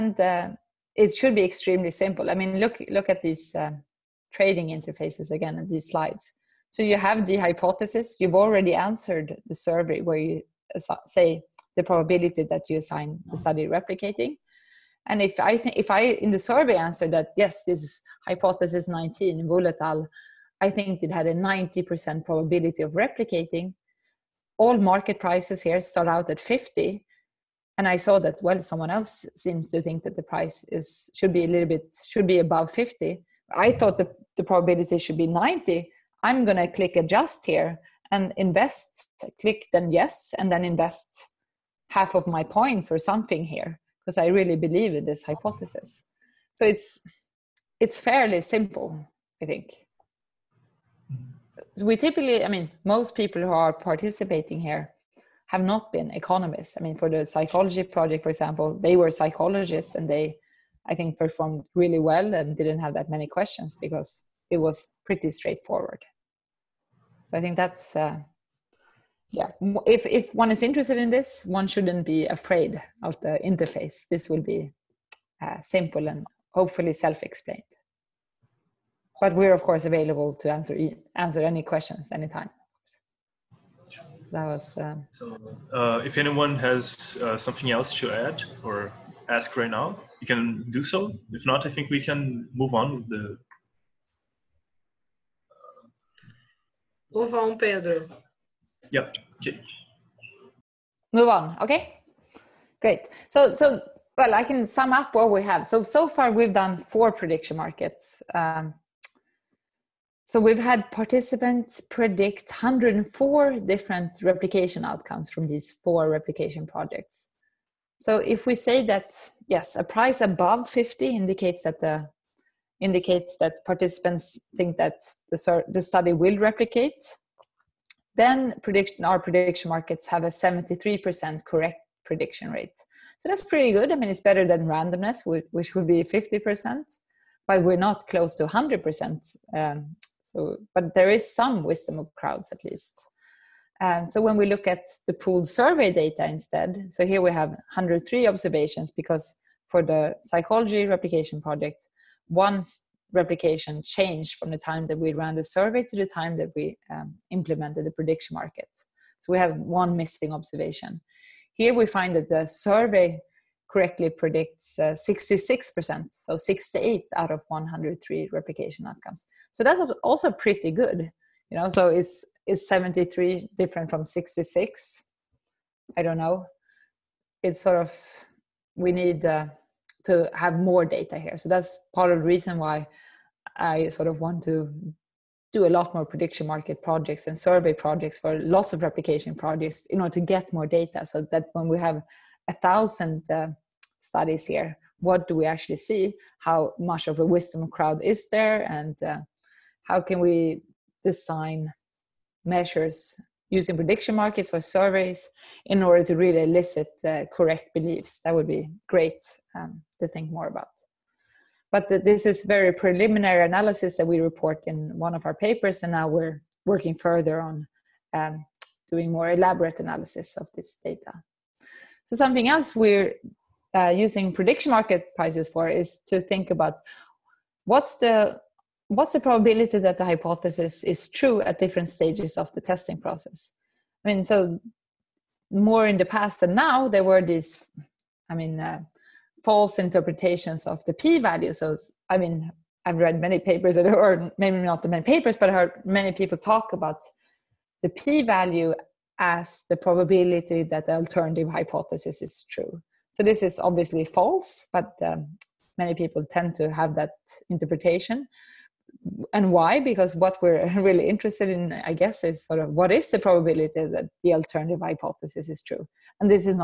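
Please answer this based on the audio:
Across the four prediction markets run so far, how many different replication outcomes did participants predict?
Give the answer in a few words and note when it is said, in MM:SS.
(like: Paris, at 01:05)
104, at 01:52.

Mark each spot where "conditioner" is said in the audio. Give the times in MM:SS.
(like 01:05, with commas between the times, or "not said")
not said.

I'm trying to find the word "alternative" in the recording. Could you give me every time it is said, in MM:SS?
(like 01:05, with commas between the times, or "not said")
04:10, 04:24.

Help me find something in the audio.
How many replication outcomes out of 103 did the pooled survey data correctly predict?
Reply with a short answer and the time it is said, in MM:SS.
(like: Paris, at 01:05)
68, at 02:46.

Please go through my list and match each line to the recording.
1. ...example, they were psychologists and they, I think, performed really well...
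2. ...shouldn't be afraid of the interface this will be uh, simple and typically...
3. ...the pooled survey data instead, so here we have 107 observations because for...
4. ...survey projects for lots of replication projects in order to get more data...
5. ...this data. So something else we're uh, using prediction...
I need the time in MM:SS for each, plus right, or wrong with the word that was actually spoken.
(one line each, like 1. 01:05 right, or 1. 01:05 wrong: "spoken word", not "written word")
1. 00:58 right
2. 01:11 wrong: "hopefully", not "typically"
3. 02:25 wrong: "103", not "107"
4. 03:07 right
5. 03:40 right.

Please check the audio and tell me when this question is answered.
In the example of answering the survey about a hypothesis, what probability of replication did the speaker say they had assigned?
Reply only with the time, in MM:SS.
00:21.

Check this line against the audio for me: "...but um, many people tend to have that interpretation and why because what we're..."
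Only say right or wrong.
right.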